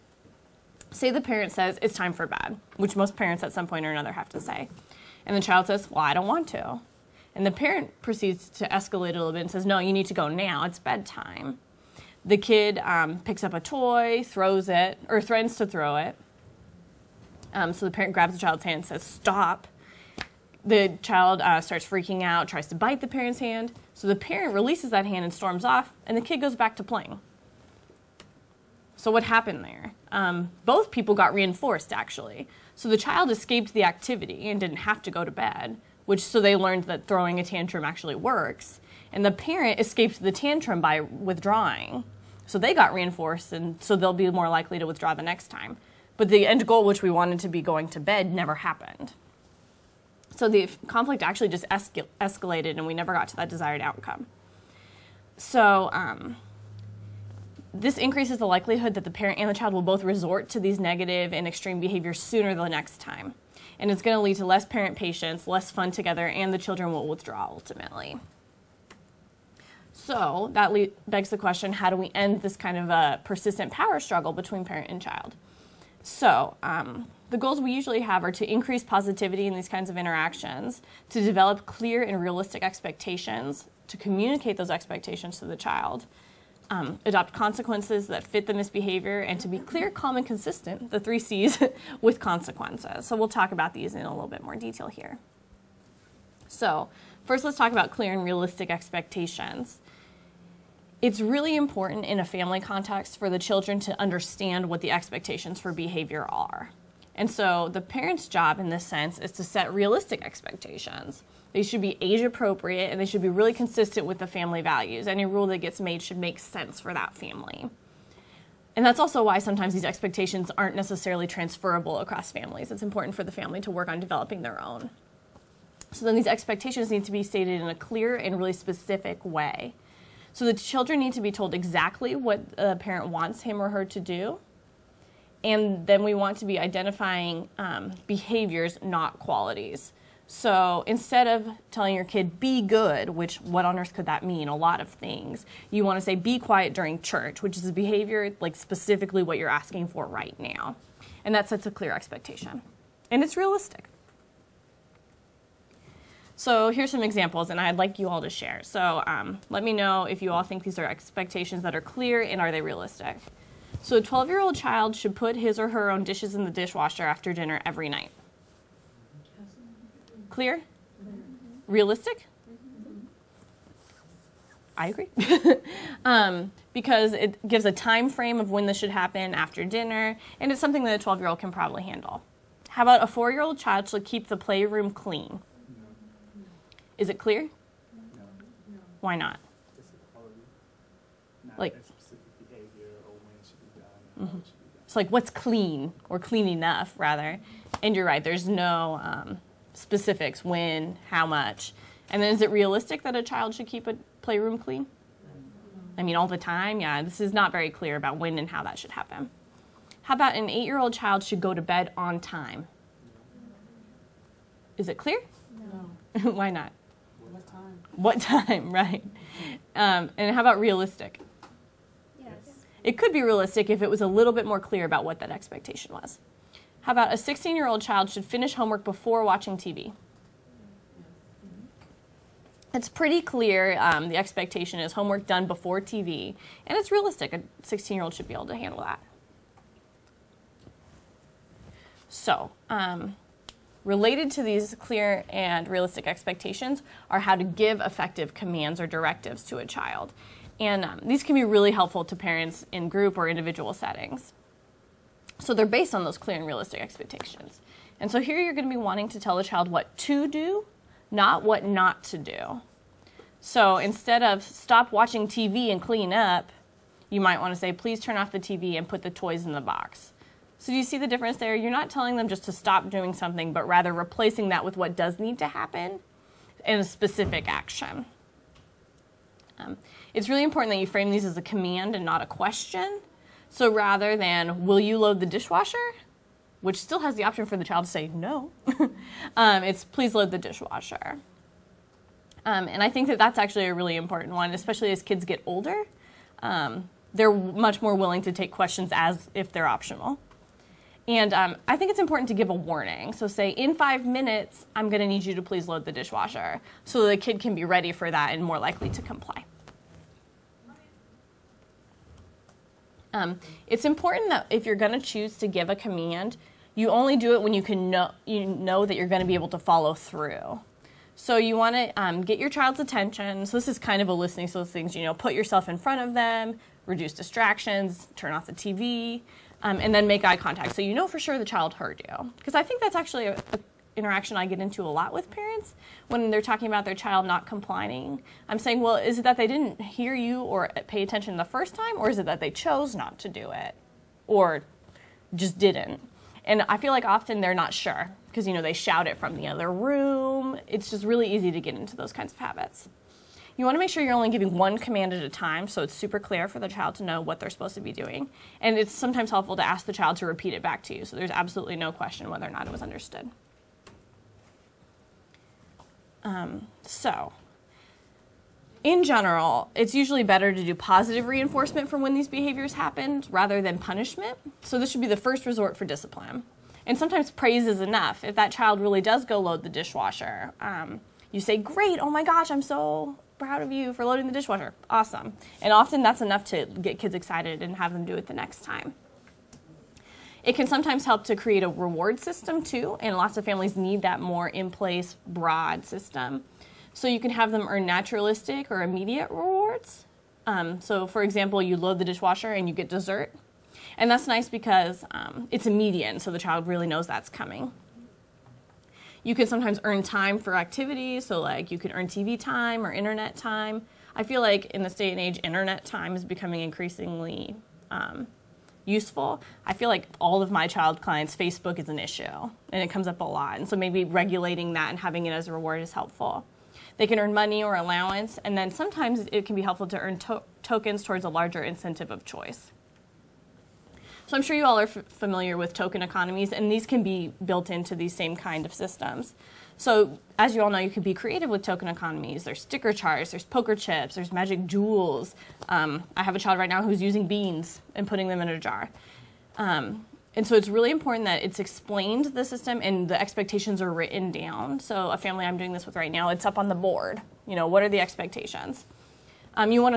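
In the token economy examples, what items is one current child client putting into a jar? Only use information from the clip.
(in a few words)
beans.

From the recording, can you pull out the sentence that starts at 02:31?
And that sets a clear expectation.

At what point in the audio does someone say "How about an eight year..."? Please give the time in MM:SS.
03:30.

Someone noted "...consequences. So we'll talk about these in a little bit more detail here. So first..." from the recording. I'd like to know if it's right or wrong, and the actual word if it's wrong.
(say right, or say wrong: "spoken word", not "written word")
right.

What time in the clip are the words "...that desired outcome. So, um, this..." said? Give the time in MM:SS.
00:53.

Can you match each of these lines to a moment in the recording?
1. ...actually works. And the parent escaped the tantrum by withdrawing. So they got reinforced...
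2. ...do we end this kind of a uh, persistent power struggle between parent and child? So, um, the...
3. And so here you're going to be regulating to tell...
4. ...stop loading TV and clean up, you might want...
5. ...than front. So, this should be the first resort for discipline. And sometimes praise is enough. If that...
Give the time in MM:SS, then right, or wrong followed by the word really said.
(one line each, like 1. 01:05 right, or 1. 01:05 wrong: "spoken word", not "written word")
1. 00:37 right
2. 01:11 right
3. 04:17 wrong: "wanting", not "regulating"
4. 04:24 wrong: "watching", not "loading"
5. 06:13 wrong: "punishment", not "front".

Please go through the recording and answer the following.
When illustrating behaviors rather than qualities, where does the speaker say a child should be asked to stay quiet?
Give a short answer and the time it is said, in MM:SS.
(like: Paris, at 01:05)
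church, at 02:27.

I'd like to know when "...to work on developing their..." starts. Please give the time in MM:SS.
02:03.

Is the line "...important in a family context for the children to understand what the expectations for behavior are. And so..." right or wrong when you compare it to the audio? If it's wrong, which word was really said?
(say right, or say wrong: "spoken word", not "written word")
right.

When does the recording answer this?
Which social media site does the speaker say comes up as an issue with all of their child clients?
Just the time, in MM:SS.
07:01.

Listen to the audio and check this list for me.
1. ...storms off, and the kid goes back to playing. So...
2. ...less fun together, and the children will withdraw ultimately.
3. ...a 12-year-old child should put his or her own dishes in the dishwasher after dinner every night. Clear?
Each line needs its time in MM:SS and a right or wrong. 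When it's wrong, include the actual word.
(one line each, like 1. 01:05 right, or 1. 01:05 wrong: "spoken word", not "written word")
1. 00:25 right
2. 01:05 right
3. 02:43 right.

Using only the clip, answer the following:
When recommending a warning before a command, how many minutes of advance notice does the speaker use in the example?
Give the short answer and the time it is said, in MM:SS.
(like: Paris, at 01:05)
5, at 05:03.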